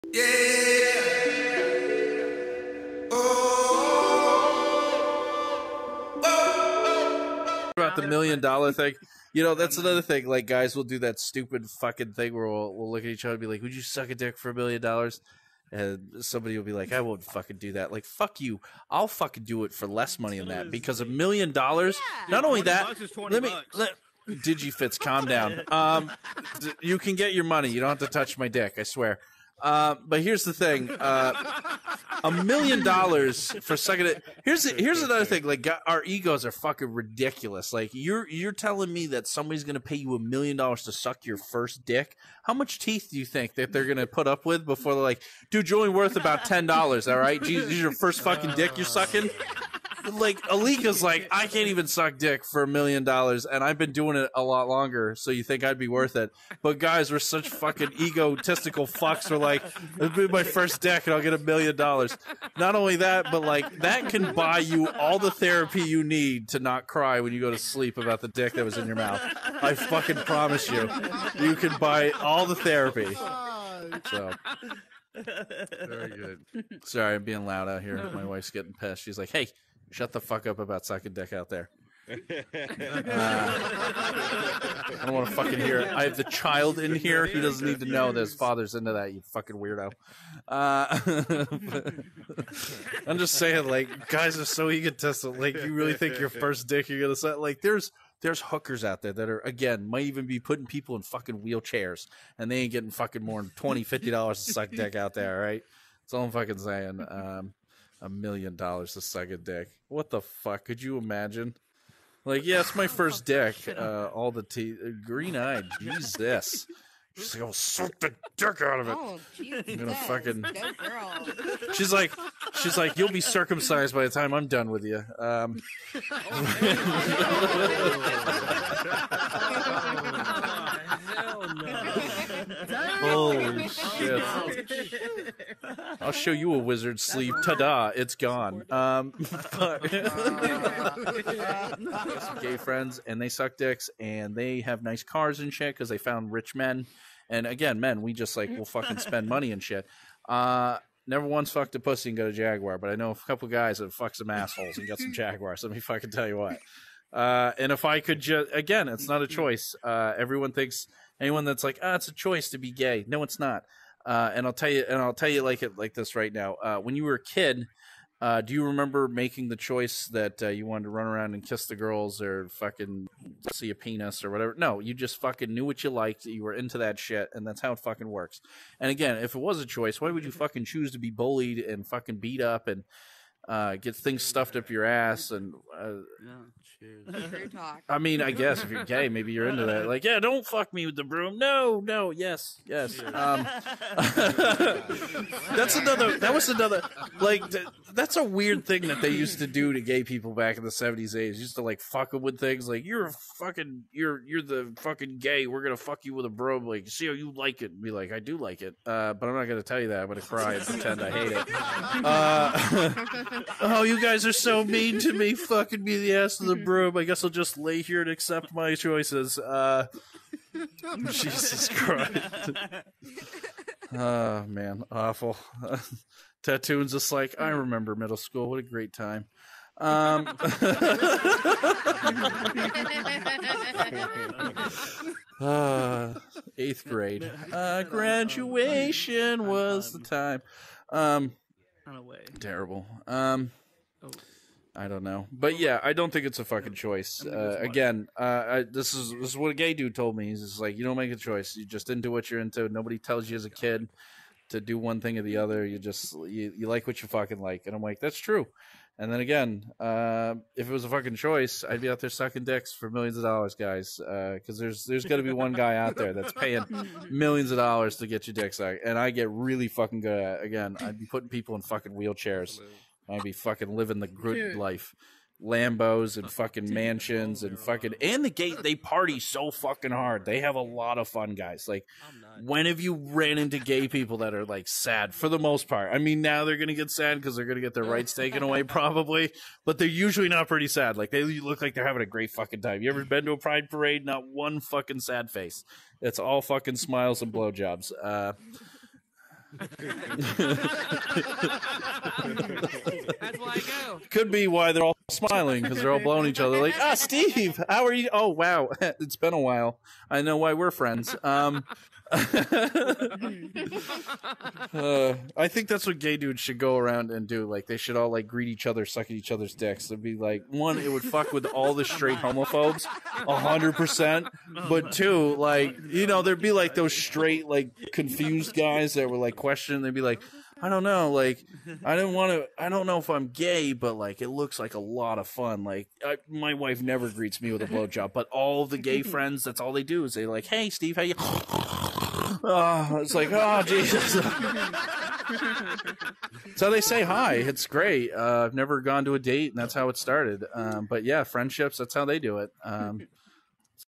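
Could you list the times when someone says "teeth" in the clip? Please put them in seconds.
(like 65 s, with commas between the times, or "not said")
42 s, 114 s.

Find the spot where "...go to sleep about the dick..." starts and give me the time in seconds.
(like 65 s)
67 s.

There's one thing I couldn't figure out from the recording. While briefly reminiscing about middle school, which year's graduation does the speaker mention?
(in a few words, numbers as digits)
eighth grade.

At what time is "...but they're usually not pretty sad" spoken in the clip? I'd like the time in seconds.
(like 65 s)
289 s.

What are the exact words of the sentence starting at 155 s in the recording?
Let me fucking tell you what.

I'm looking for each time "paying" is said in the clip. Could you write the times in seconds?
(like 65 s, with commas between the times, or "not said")
266 s.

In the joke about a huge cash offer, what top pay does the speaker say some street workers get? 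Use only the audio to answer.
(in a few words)
$20.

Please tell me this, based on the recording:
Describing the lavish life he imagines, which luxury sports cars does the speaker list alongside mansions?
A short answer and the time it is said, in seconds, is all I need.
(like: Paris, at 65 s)
Lambos, at 275 s.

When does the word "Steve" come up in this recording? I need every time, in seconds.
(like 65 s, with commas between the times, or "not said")
306 s, 340 s.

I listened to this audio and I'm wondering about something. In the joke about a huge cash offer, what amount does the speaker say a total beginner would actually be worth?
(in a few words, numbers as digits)
$10.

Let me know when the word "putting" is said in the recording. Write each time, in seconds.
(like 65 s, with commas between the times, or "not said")
100 s, 271 s.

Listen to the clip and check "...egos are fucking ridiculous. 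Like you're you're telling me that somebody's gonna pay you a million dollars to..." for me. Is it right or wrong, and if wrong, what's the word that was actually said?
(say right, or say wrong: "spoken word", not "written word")
right.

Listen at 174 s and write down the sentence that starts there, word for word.
No, you just fucking knew what you liked.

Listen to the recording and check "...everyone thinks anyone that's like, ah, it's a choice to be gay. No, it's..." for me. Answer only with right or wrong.
right.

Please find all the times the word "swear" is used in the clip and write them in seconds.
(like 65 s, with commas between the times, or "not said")
28 s.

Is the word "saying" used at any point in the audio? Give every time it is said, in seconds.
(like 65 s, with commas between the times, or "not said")
93 s, 106 s.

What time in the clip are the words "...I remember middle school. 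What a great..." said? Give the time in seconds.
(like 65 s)
227 s.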